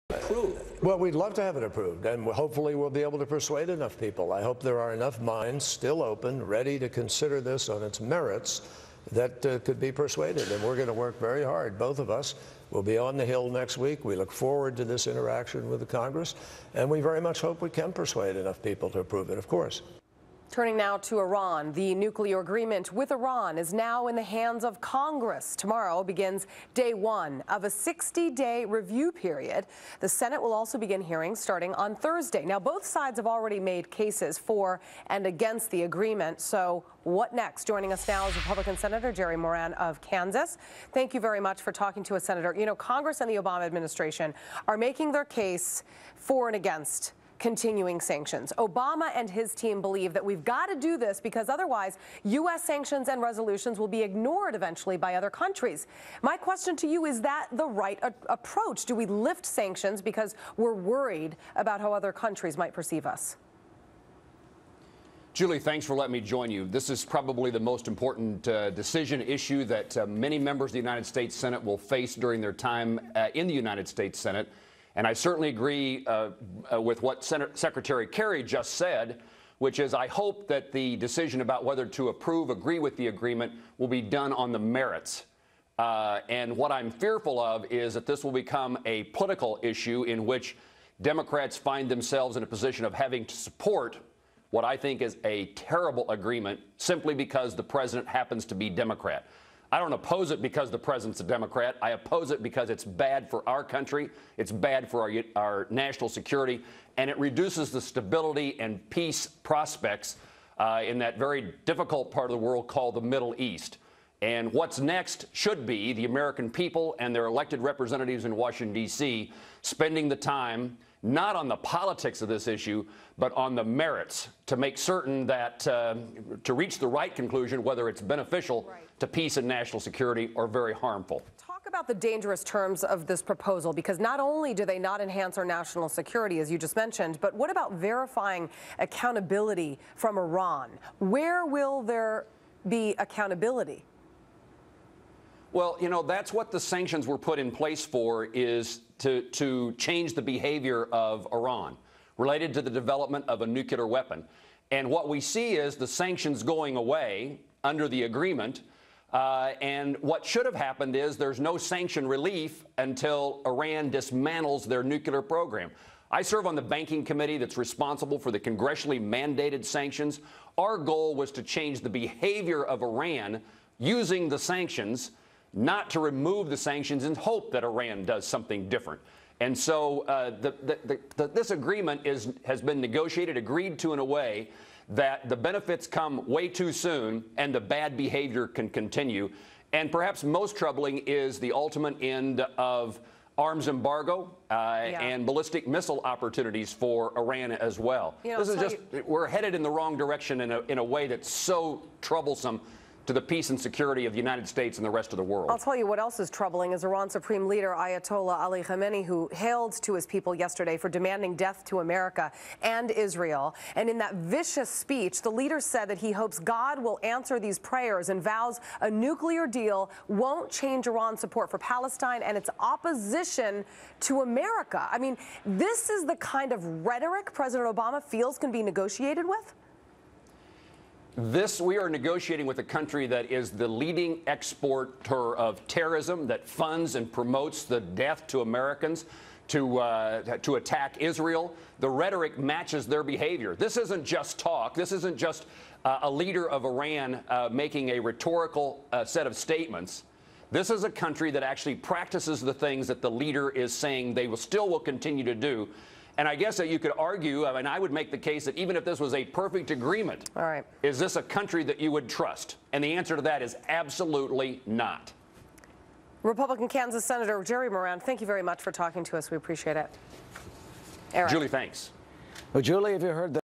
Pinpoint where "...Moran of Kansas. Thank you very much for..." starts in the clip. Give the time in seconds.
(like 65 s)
39 s.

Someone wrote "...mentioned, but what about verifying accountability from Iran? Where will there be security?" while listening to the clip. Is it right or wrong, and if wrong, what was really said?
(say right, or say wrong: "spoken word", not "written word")
wrong: "accountability", not "security".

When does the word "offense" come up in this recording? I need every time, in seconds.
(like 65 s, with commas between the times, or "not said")
not said.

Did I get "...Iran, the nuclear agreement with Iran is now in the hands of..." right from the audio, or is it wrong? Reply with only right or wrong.
right.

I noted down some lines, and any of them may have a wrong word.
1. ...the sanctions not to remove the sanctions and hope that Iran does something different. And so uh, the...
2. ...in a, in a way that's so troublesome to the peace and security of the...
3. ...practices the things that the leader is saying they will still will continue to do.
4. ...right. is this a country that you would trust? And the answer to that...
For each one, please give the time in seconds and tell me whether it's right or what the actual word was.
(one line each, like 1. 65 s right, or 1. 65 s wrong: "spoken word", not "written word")
1. 174 s right
2. 200 s right
3. 251 s right
4. 260 s right.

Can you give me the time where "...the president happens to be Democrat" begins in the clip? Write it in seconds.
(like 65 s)
97 s.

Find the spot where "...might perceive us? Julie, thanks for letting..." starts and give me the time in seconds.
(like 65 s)
62 s.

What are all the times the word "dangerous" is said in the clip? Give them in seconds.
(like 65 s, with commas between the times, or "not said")
131 s.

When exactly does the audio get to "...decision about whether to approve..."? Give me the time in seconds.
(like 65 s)
80 s.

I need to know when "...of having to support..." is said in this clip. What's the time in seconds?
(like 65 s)
92 s.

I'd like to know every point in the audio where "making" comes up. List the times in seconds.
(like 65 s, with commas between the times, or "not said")
44 s, 247 s.